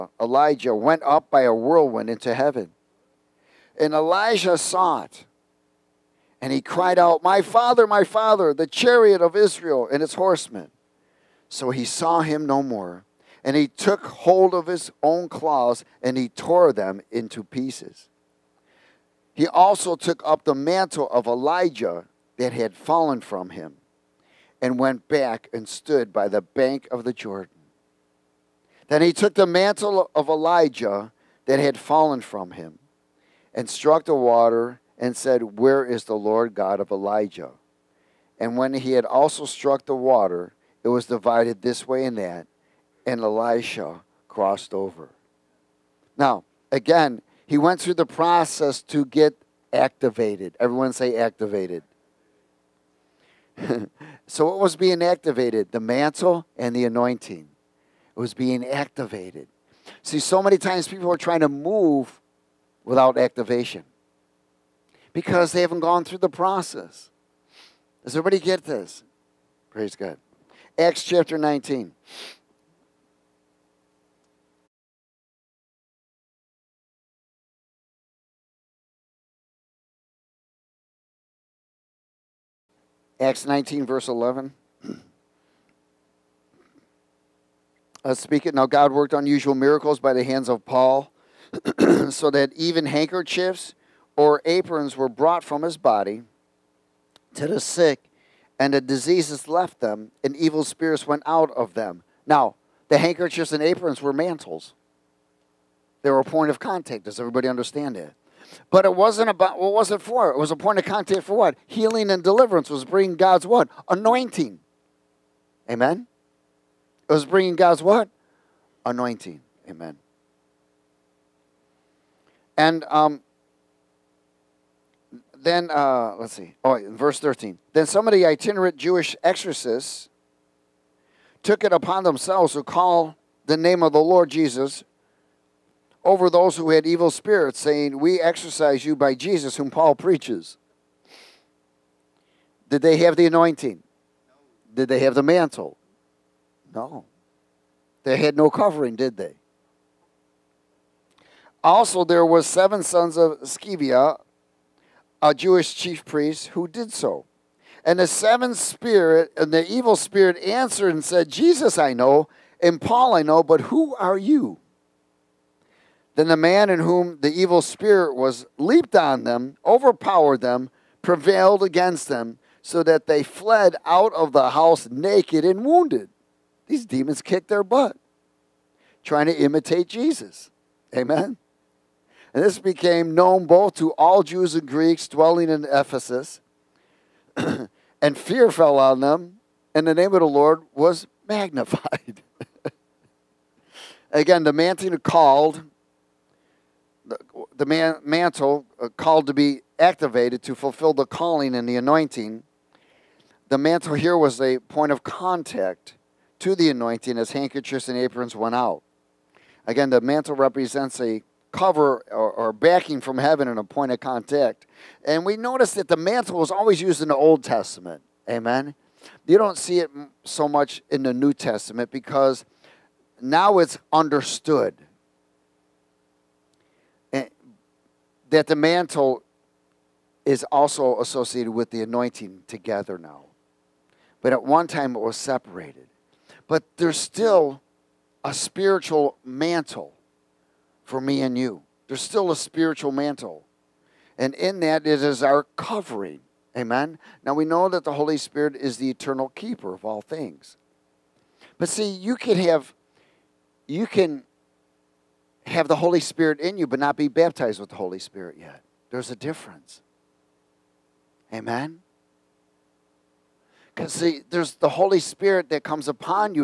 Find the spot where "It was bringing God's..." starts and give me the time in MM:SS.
01:57.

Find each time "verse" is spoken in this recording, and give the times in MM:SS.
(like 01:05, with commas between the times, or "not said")
01:23, 02:06.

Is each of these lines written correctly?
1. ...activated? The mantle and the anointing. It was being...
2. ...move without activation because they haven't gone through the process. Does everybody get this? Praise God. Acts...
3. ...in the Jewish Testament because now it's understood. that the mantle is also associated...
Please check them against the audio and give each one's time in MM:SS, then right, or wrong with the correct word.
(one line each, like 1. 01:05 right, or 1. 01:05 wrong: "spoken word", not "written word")
1. 00:55 right
2. 01:01 right
3. 03:40 wrong: "New", not "Jewish".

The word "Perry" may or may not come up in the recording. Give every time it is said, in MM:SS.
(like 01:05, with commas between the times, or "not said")
not said.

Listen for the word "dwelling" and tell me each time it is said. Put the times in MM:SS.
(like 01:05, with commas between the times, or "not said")
03:05.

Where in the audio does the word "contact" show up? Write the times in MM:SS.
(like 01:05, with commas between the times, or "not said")
01:46, 01:50, 03:25, 03:33.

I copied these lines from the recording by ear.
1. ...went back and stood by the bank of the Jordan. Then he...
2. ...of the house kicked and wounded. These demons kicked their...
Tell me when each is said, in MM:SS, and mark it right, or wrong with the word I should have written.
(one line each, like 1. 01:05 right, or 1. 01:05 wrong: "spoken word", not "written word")
1. 00:24 right
2. 02:54 wrong: "naked", not "kicked".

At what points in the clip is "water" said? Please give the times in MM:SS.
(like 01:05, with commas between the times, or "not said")
00:34, 00:39.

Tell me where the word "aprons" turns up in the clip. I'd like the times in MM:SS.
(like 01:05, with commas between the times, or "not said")
01:34, 01:43, 03:27.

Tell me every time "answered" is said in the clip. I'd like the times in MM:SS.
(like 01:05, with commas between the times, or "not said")
02:40.